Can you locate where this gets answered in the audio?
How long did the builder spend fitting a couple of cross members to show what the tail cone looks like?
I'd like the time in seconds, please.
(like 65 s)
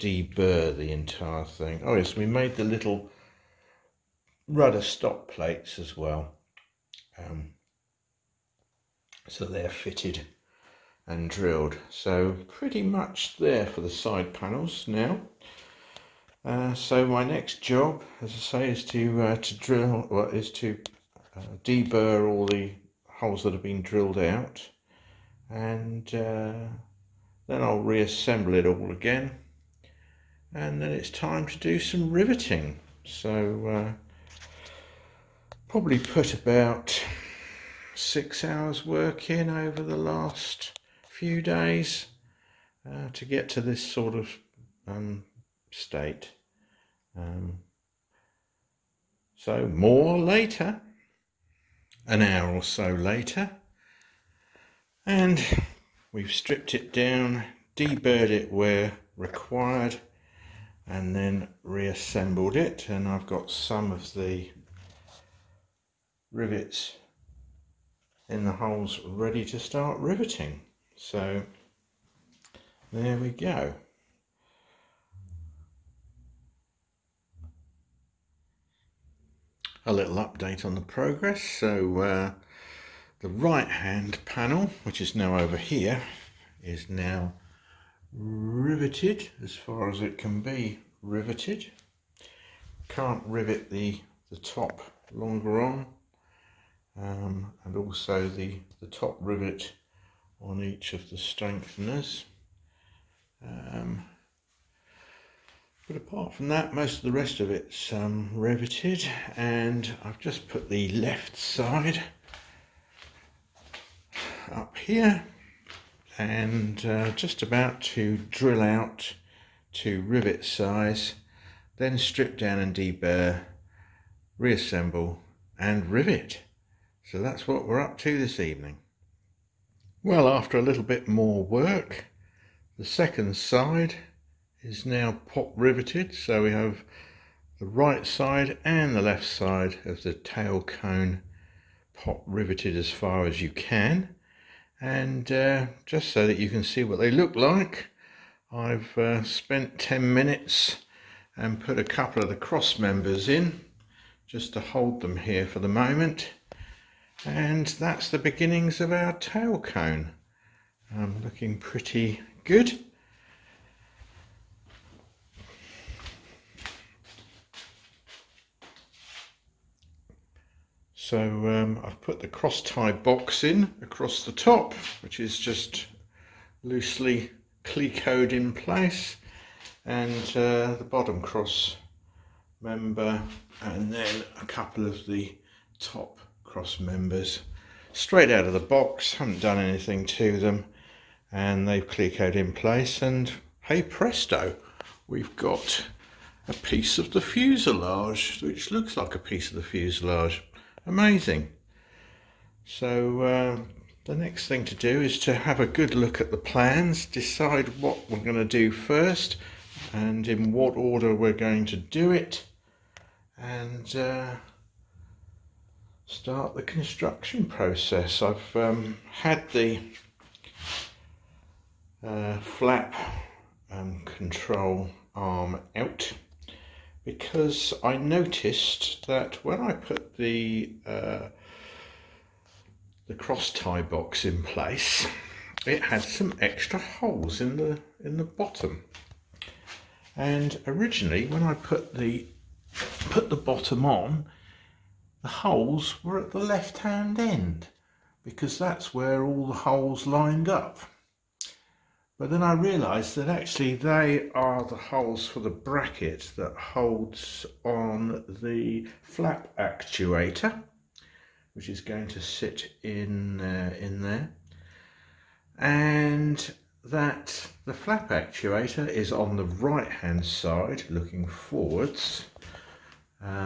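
149 s.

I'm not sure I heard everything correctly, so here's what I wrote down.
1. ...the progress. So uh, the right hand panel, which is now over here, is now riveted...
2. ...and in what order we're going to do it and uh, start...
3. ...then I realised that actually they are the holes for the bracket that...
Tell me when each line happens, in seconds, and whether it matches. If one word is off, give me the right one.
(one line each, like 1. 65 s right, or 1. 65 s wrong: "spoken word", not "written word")
1. 80 s right
2. 209 s right
3. 252 s right.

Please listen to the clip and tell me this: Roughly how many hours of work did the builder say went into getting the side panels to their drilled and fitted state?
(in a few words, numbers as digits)
6 hours.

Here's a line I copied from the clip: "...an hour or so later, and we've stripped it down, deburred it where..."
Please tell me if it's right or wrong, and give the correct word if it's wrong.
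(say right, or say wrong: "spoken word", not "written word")
right.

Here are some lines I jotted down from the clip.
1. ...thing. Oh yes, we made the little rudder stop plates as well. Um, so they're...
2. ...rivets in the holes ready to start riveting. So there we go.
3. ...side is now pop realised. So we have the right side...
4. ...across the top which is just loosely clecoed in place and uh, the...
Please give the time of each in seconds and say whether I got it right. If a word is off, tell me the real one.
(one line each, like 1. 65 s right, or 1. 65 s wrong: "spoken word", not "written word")
1. 1 s right
2. 66 s right
3. 133 s wrong: "riveted", not "realised"
4. 173 s right.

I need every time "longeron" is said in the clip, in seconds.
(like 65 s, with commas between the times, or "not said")
95 s.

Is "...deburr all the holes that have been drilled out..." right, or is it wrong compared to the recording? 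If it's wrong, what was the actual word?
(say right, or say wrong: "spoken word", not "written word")
right.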